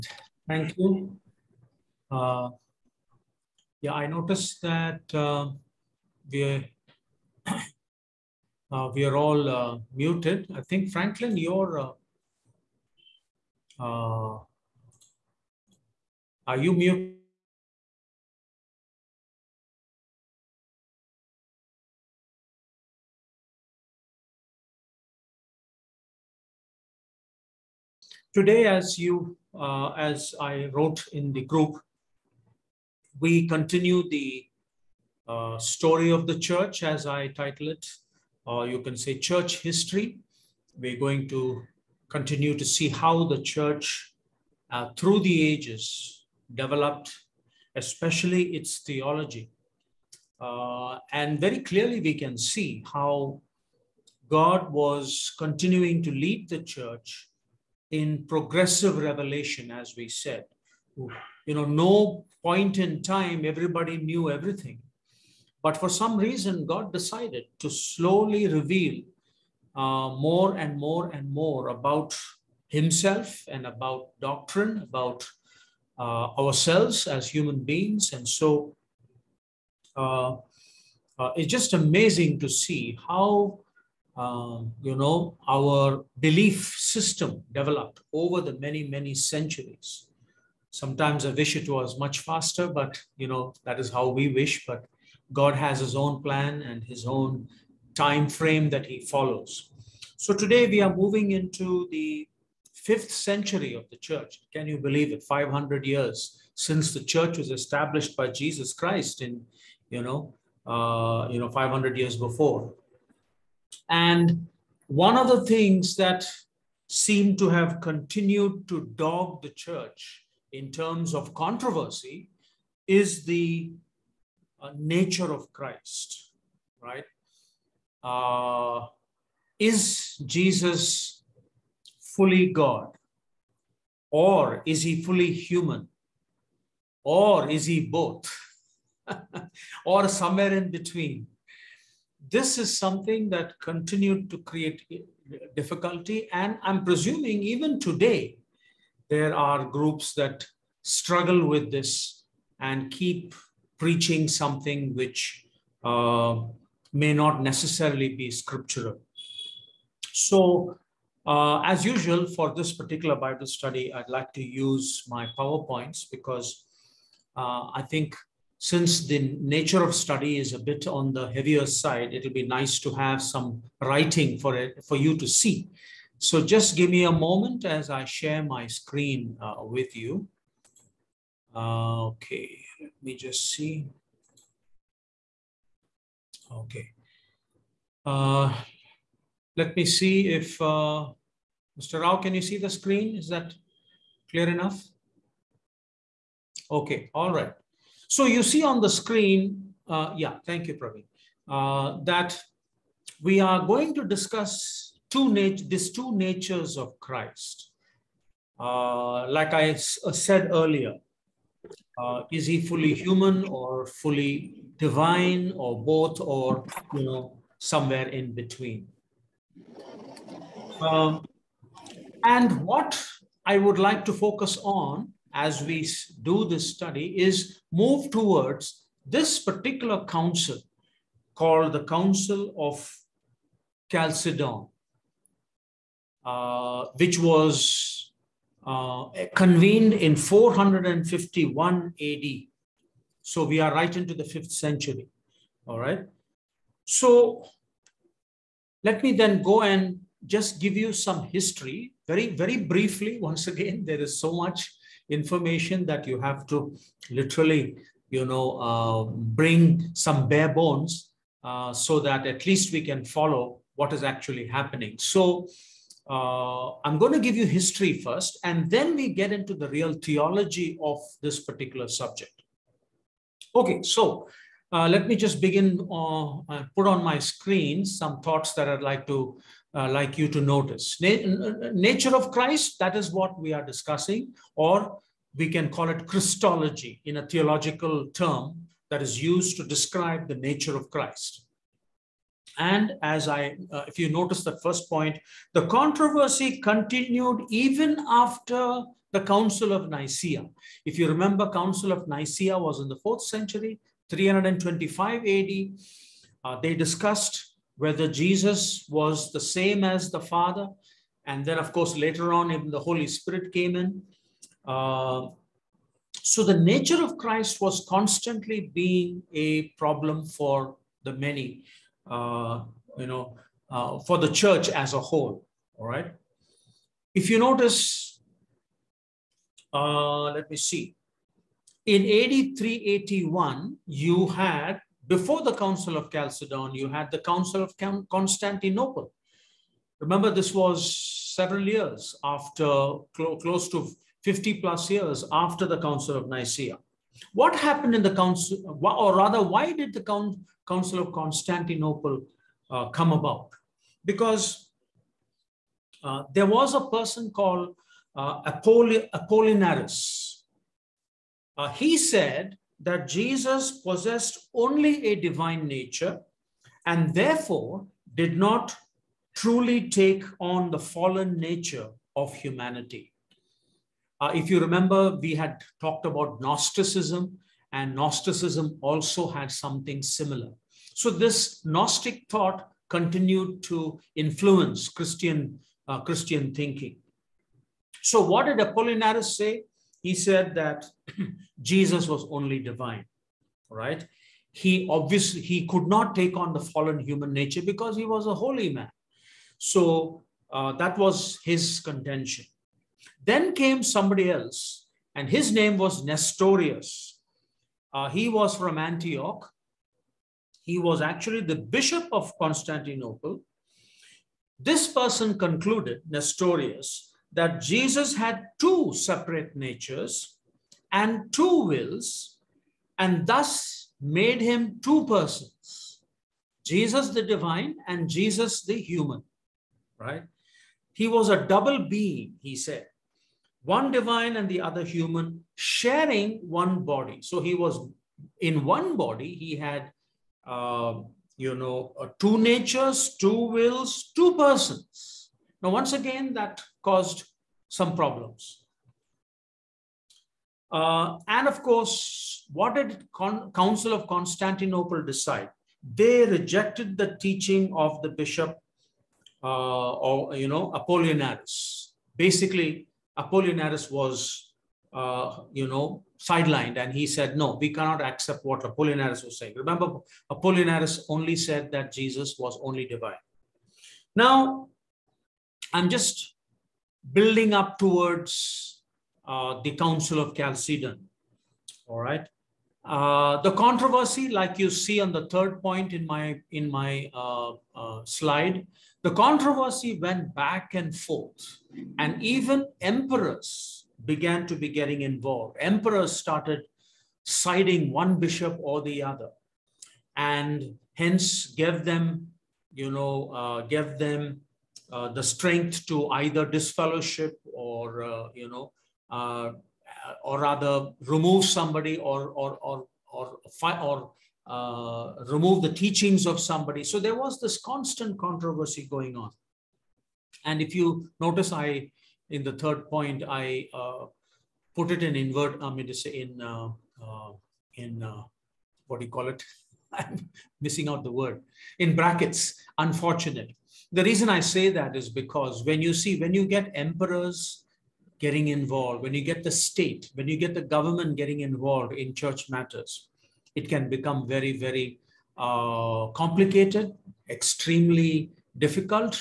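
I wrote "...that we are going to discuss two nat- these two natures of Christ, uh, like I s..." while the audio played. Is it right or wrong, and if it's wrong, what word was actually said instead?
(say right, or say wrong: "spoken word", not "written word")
right.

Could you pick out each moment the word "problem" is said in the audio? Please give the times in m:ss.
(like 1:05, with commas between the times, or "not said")
5:19, 7:27.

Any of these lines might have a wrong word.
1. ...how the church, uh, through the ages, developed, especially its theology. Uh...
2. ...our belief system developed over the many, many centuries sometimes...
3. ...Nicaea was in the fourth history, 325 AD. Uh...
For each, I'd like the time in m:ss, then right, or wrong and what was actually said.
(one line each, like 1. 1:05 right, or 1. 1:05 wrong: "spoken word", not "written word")
1. 0:42 right
2. 1:25 right
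3. 5:02 wrong: "century", not "history".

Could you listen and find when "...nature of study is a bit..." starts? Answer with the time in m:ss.
2:49.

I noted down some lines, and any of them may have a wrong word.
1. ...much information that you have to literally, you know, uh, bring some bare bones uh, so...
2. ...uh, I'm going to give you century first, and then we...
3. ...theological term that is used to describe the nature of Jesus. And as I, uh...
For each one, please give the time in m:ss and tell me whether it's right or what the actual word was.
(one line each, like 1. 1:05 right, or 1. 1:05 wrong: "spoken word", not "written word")
1. 4:14 right
2. 4:26 wrong: "history", not "century"
3. 4:47 wrong: "Christ", not "Jesus".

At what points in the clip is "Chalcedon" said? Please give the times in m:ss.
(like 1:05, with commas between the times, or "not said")
3:53, 5:36, 8:00.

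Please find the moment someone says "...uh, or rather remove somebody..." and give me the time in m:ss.
8:29.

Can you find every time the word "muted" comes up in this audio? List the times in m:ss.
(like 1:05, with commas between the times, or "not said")
0:09, 0:16.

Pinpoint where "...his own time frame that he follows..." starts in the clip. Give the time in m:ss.
1:36.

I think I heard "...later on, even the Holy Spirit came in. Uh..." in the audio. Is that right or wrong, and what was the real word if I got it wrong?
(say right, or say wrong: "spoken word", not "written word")
right.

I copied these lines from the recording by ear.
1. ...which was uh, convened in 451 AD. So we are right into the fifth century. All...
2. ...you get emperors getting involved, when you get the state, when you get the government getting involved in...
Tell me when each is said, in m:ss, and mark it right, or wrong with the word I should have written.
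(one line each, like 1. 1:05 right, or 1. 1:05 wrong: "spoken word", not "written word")
1. 3:56 right
2. 8:56 right.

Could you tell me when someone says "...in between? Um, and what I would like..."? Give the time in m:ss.
3:38.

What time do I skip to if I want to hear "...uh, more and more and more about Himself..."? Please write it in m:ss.
1:09.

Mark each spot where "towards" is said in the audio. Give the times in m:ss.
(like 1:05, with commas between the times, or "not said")
3:48, 7:57.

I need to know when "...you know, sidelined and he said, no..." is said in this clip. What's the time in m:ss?
7:45.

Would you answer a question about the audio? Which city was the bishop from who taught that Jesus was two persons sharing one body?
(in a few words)
Antioch.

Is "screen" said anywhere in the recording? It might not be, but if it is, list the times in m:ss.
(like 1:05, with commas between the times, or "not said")
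2:58, 3:12, 3:18, 4:37.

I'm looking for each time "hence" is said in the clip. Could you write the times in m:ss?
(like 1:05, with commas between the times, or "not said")
8:20.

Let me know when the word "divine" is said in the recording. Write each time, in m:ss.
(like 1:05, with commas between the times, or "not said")
3:34, 6:05, 6:32, 7:07, 7:13, 7:52.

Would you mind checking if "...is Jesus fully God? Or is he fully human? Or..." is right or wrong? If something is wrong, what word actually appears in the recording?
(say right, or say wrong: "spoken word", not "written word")
right.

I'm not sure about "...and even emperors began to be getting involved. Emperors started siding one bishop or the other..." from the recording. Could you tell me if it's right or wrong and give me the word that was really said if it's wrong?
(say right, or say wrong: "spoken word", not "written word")
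right.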